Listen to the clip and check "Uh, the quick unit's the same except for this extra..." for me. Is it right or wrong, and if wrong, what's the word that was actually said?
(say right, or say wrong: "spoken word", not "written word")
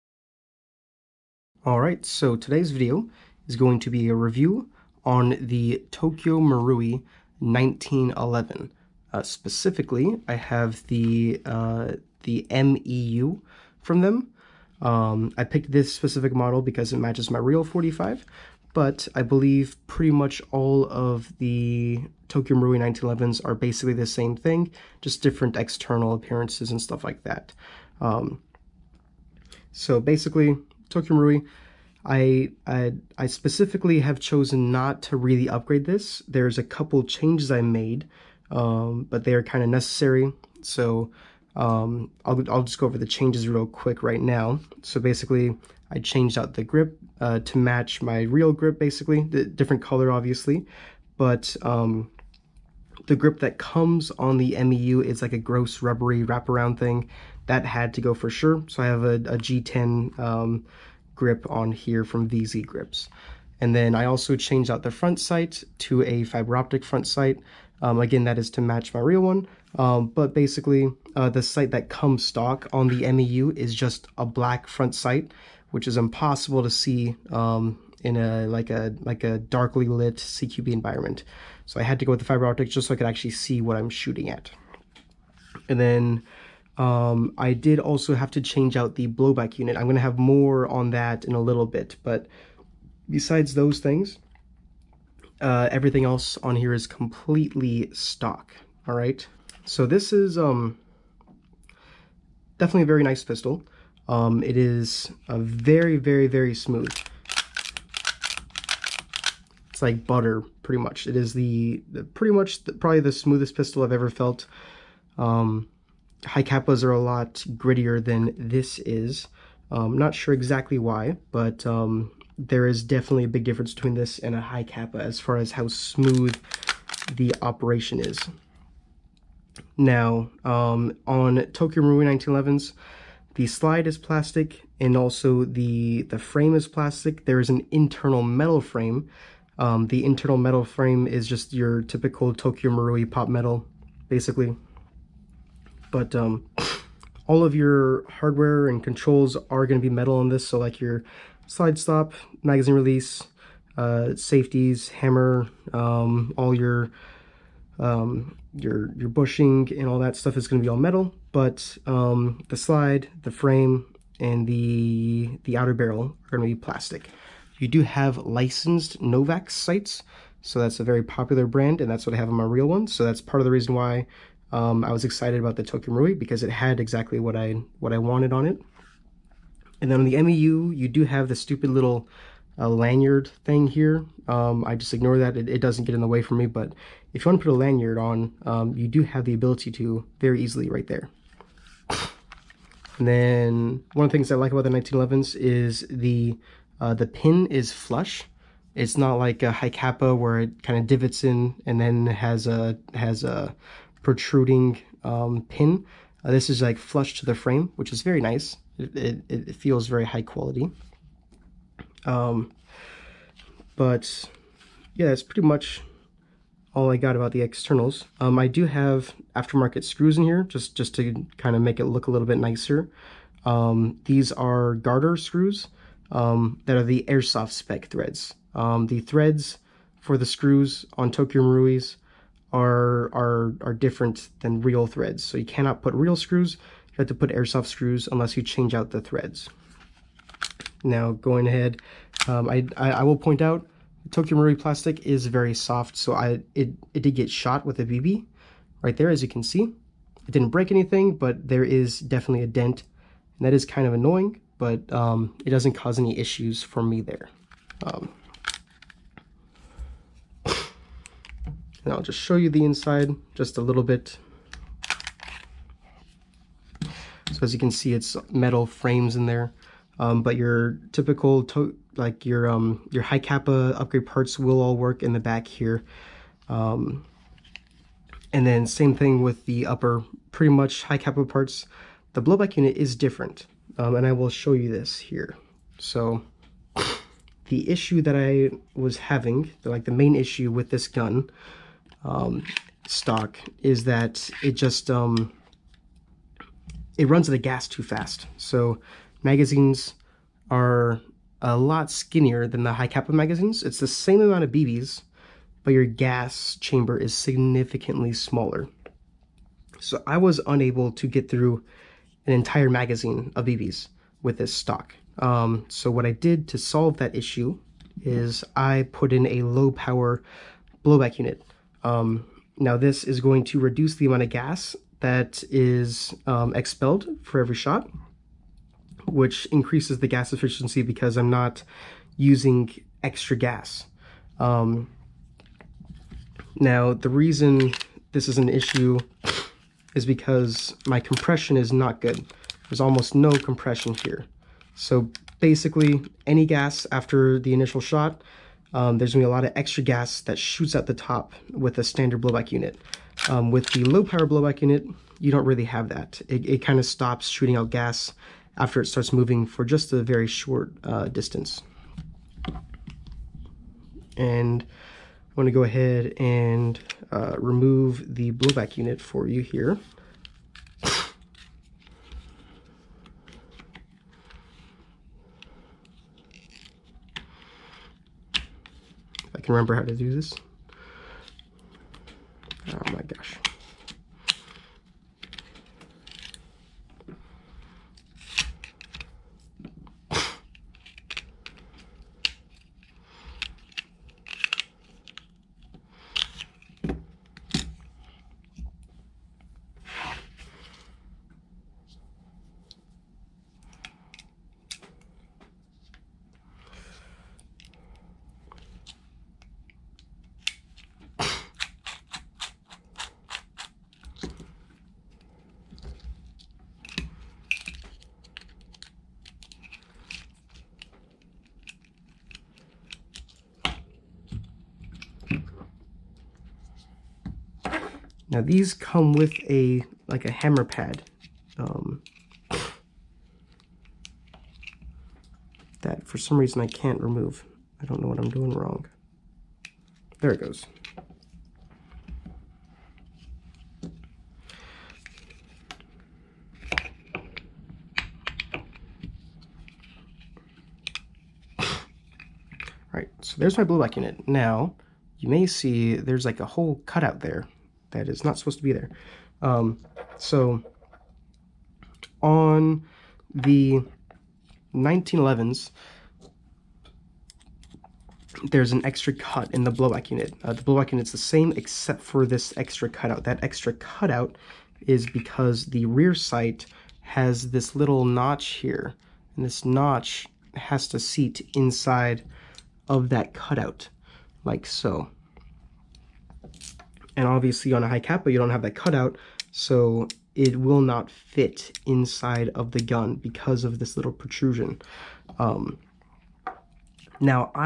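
wrong: "blowback", not "quick".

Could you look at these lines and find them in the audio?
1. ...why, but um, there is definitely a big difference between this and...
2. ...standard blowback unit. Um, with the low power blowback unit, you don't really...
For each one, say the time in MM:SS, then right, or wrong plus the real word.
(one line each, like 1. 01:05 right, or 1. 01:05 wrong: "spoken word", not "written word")
1. 02:00 right
2. 05:51 right.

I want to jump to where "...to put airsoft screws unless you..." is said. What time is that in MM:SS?
03:57.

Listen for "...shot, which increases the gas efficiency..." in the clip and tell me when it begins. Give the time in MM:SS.
05:27.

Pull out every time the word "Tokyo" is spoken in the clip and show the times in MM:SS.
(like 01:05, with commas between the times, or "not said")
00:05, 00:22, 00:30, 02:11, 02:22, 02:55, 03:51, 04:04.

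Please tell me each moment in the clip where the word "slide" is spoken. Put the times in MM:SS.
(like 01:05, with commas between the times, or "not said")
02:13, 02:31, 02:42.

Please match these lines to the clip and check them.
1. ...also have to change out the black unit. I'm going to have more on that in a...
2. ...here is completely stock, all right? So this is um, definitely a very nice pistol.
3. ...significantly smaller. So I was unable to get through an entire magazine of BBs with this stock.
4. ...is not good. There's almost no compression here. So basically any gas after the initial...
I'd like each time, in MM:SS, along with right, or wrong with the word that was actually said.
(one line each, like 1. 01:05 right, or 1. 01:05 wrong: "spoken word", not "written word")
1. 01:27 wrong: "blowback", not "black"
2. 01:36 right
3. 05:07 right
4. 05:41 right.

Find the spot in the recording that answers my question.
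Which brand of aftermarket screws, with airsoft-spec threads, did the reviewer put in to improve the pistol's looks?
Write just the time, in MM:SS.
03:44.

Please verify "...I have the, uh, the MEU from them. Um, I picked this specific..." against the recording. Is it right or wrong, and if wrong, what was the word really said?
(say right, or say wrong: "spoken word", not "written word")
right.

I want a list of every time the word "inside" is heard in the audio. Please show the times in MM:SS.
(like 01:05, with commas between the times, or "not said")
04:22, 08:01, 08:11.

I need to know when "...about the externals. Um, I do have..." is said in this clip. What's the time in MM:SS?
03:37.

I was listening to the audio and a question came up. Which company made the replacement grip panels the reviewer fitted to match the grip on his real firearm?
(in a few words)
VZ Grips.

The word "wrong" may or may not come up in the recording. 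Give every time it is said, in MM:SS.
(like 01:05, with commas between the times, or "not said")
07:18.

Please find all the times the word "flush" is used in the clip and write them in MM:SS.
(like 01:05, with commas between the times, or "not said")
03:17, 03:26.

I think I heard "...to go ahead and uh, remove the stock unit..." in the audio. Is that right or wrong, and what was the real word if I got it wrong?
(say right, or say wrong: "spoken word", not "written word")
wrong: "blowback", not "stock".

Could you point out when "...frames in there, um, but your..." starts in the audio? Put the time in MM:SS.
04:28.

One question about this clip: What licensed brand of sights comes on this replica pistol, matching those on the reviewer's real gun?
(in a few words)
Novak's.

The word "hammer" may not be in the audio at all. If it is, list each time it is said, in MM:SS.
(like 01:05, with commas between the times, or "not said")
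02:34, 07:10.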